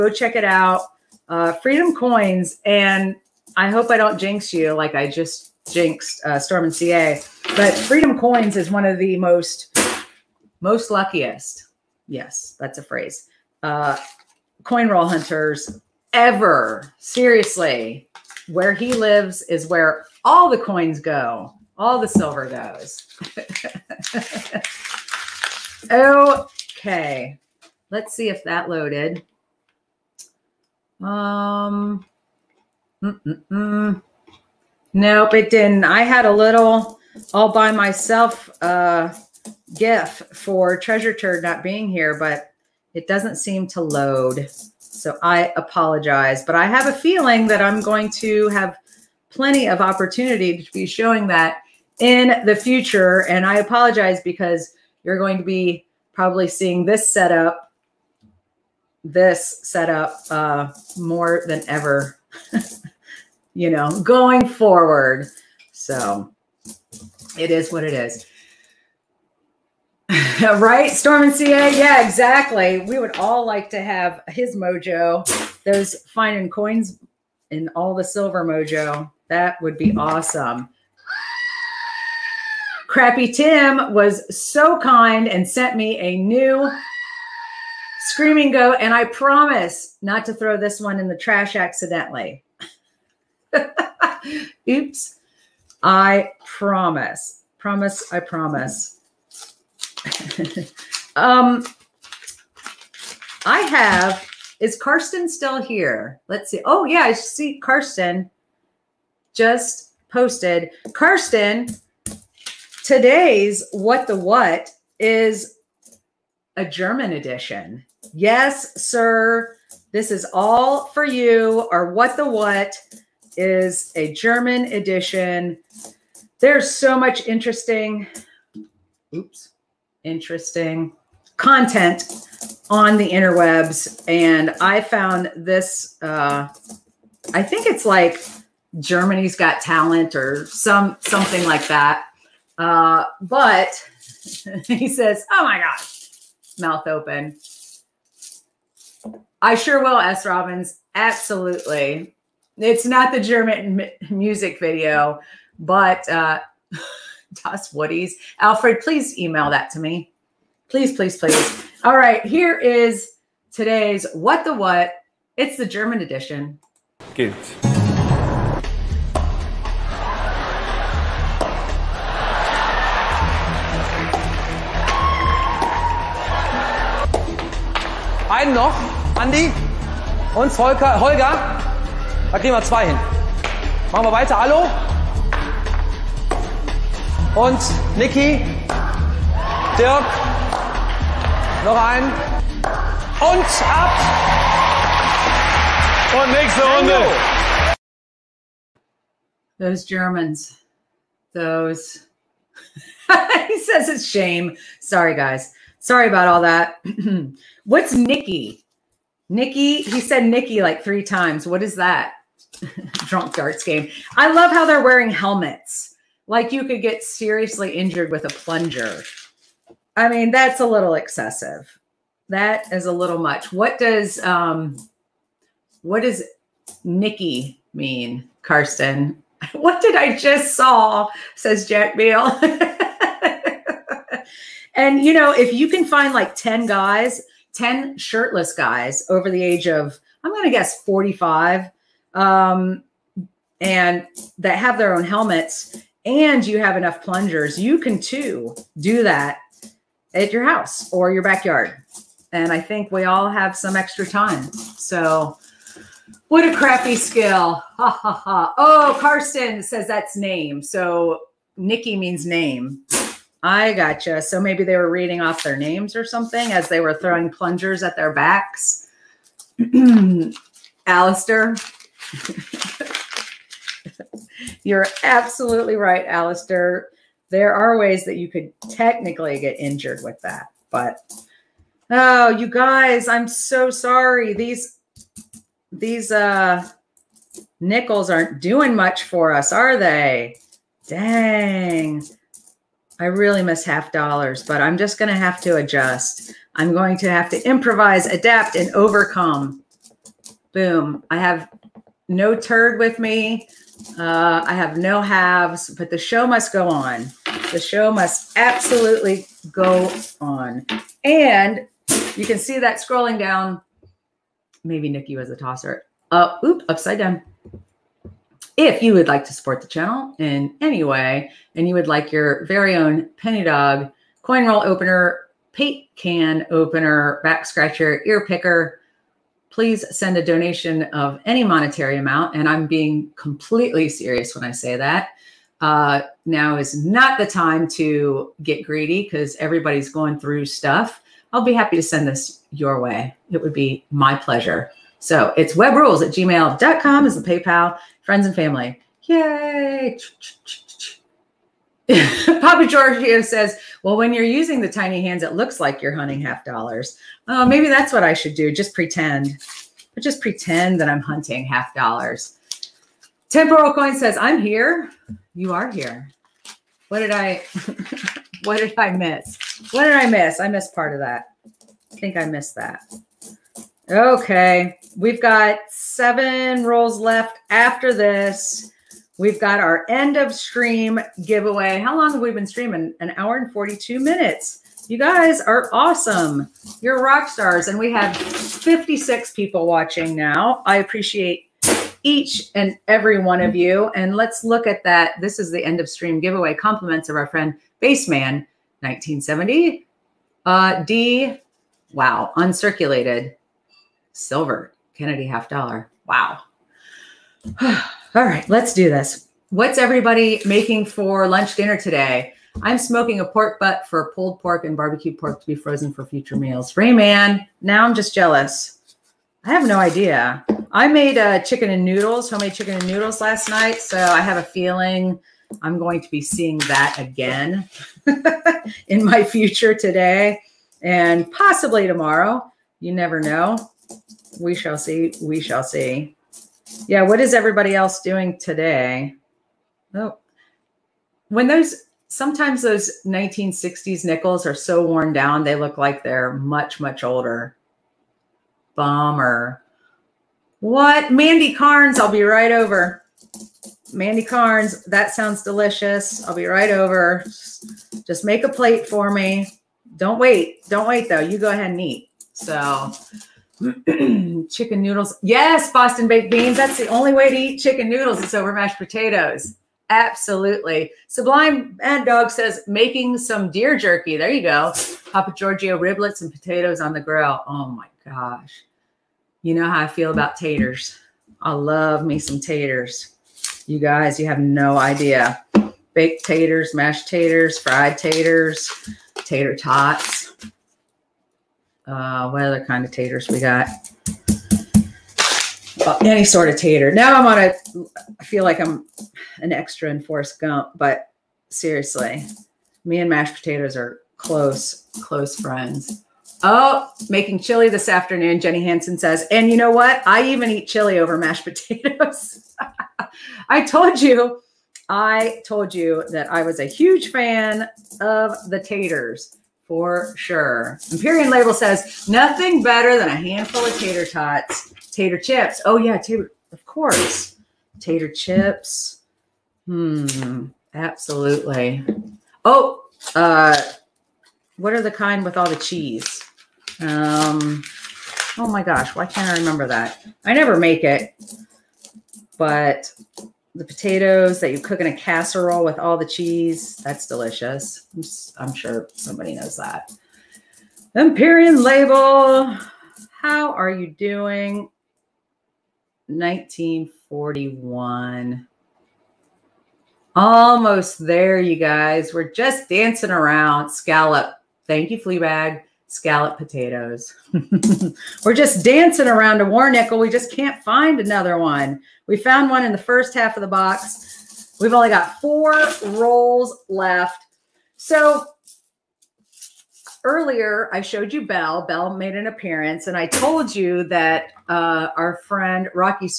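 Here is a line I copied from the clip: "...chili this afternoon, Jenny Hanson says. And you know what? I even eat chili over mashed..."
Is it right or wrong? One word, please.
right.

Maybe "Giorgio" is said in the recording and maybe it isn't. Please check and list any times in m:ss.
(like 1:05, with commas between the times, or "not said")
5:52, 7:55.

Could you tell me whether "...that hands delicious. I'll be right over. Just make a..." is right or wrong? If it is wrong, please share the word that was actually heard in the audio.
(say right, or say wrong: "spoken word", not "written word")
wrong: "sounds", not "hands".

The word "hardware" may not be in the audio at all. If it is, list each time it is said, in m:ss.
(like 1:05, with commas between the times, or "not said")
not said.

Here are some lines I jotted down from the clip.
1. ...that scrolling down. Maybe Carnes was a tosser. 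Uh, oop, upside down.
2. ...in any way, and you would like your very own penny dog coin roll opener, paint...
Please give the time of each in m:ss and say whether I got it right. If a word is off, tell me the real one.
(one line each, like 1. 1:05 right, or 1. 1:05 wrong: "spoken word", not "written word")
1. 5:12 wrong: "Nikki", not "Carnes"
2. 5:20 right.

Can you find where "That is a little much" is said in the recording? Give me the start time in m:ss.
3:42.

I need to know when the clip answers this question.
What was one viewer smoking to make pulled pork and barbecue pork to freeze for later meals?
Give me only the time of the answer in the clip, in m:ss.
6:53.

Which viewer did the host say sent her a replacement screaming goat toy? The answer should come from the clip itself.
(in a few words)
Crabby Tim.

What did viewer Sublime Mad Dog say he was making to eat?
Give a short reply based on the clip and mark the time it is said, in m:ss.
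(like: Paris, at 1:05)
deer jerky, at 7:53.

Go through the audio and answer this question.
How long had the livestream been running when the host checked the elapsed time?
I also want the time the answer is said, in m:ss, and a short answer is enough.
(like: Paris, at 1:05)
1 hour 42 minutes, at 6:22.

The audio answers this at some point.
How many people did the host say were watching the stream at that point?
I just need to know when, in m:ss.
6:28.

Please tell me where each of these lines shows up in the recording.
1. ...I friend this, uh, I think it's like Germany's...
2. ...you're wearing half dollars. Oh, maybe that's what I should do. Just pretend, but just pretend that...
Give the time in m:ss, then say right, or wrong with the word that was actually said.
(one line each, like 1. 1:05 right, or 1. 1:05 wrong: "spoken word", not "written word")
1. 2:14 wrong: "found", not "friend"
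2. 5:55 wrong: "hunting", not "wearing".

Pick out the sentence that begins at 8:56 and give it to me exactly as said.
Um, oh my gosh, why can't I remember that?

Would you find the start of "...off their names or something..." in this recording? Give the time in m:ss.
4:25.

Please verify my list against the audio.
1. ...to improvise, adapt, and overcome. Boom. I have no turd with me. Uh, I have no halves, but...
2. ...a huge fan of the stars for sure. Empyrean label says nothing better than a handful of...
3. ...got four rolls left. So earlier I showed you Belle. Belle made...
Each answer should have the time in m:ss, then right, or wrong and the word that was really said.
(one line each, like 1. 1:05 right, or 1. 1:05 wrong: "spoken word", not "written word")
1. 4:57 right
2. 8:36 wrong: "taters", not "stars"
3. 9:34 right.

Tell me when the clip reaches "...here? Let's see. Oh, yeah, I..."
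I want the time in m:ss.
1:45.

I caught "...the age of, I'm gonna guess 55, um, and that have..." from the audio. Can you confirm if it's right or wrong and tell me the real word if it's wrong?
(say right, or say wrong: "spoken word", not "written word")
wrong: "45", not "55".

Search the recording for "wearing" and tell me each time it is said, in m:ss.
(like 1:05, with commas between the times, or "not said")
3:34.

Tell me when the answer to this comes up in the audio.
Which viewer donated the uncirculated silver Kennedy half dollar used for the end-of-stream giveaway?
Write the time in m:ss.
6:37.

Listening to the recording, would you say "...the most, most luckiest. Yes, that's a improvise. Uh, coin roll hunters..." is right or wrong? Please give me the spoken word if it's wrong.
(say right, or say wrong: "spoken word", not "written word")
wrong: "phrase", not "improvise".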